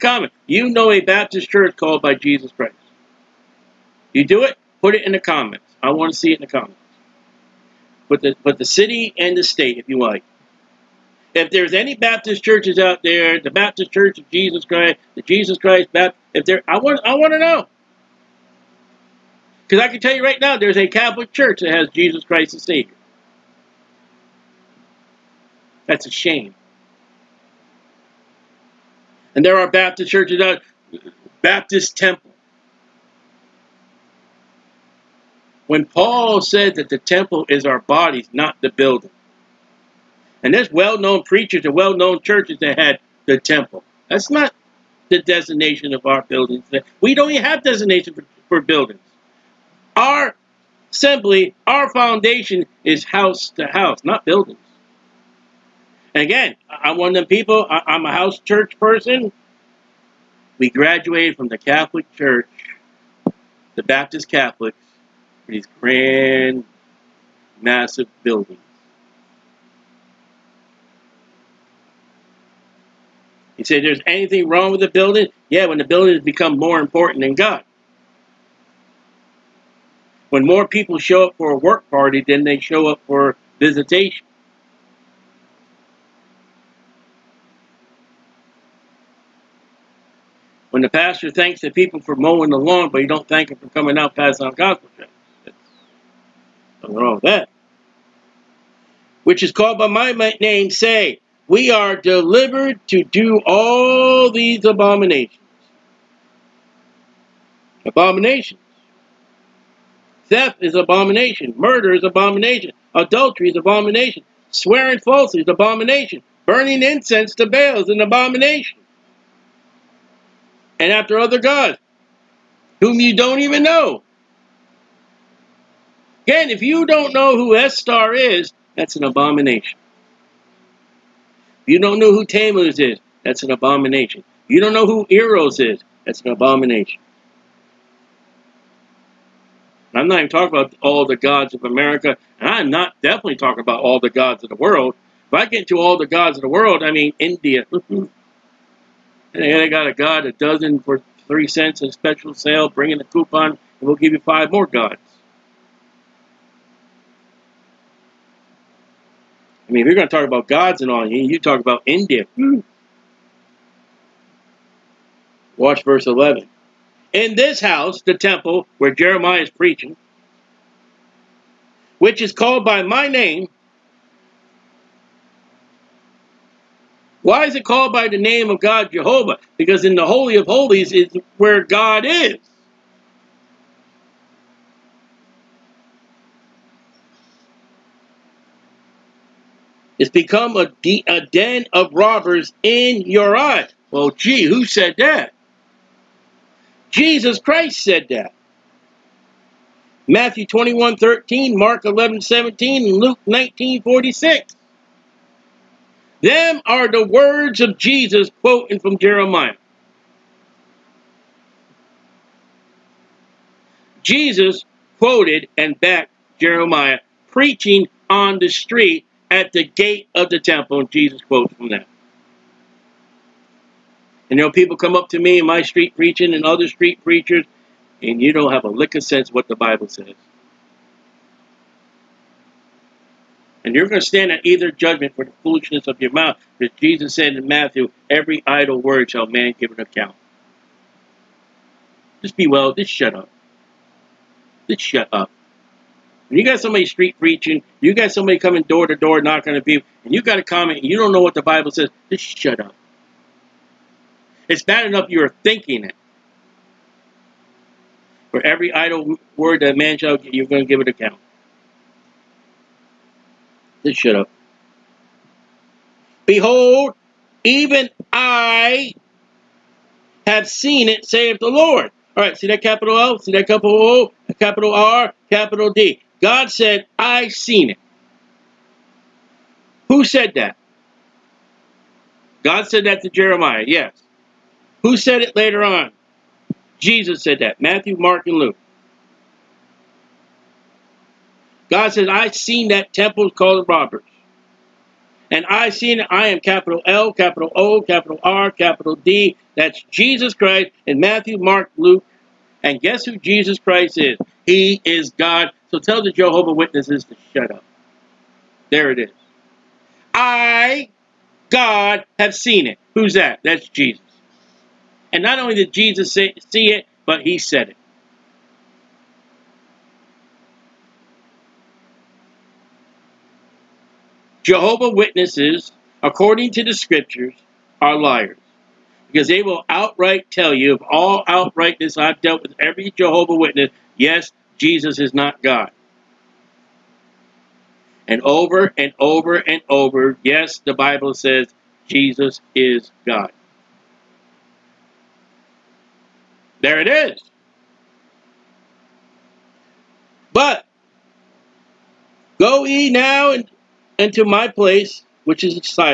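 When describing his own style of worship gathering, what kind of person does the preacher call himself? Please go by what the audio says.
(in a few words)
a house church person.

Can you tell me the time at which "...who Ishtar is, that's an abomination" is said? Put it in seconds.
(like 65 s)
127 s.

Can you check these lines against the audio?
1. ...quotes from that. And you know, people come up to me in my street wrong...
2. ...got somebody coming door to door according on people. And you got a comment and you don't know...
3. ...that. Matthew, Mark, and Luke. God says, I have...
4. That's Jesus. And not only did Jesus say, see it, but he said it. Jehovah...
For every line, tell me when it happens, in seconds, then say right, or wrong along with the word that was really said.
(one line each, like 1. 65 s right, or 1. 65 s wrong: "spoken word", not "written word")
1. 221 s wrong: "preaching", not "wrong"
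2. 247 s wrong: "knocking", not "according"
3. 287 s right
4. 313 s right.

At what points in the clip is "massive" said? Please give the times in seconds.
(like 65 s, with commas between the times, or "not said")
67 s.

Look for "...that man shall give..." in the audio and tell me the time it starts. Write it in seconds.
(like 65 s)
259 s.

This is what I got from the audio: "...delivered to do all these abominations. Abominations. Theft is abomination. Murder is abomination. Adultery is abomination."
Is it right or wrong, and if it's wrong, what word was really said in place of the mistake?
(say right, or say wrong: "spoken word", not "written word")
right.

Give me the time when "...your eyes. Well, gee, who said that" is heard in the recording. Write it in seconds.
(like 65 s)
193 s.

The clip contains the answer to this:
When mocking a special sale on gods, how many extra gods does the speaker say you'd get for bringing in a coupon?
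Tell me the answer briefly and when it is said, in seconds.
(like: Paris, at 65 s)
5, at 154 s.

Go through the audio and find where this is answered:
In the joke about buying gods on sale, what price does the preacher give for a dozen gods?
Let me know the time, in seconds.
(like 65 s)
151 s.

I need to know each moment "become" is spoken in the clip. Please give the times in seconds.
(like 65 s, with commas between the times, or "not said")
76 s, 190 s.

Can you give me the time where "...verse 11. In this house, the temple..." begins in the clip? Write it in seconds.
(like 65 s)
165 s.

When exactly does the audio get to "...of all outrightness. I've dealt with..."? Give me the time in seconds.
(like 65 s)
330 s.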